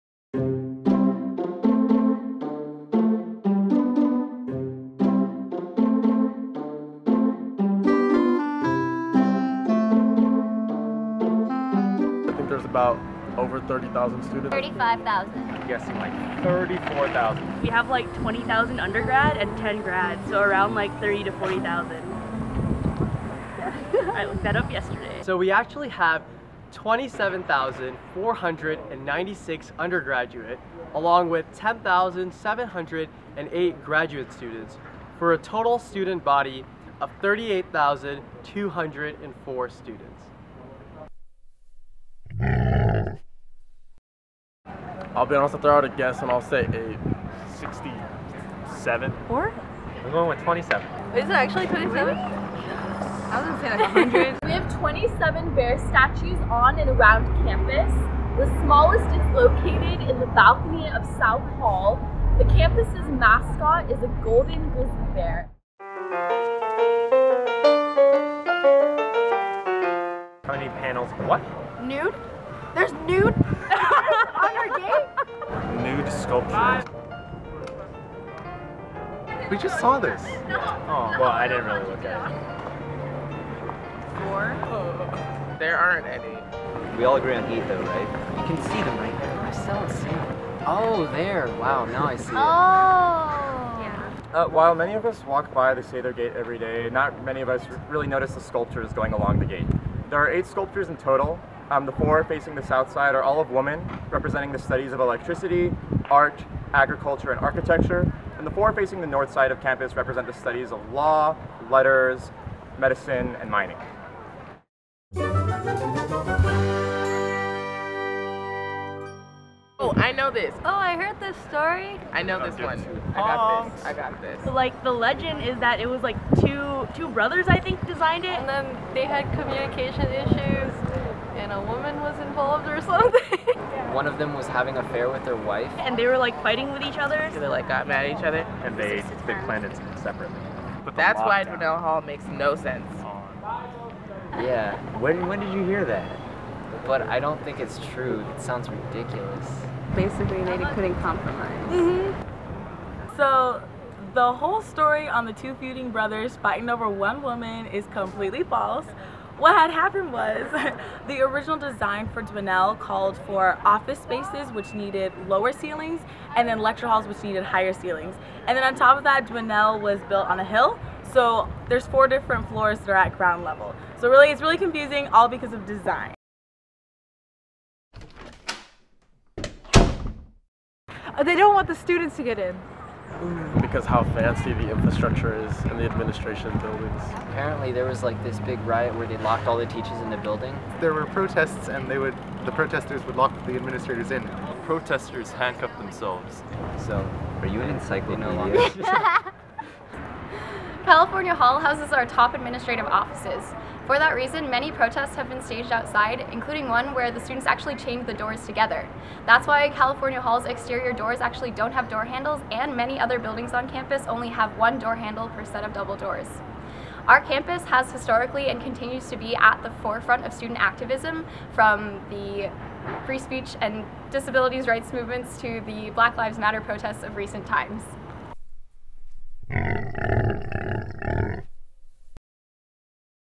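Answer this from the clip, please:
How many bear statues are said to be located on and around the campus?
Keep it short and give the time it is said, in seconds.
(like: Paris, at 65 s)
27, at 54 s.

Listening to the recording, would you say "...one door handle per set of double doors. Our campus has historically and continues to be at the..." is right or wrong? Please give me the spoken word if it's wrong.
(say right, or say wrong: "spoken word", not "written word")
right.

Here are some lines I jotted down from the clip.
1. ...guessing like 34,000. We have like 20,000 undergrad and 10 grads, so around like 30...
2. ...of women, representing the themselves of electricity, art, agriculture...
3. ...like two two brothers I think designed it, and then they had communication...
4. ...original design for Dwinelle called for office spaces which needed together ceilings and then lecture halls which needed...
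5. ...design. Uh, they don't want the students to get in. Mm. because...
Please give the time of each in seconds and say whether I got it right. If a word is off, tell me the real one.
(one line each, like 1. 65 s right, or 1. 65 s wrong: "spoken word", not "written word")
1. 15 s right
2. 103 s wrong: "studies", not "themselves"
3. 126 s right
4. 161 s wrong: "lower", not "together"
5. 175 s right.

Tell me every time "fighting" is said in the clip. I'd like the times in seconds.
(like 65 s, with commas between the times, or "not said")
136 s, 156 s.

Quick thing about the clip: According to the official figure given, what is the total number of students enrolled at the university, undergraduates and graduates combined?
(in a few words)
38,204.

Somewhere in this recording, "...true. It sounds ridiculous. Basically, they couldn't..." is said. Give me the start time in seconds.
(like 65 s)
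147 s.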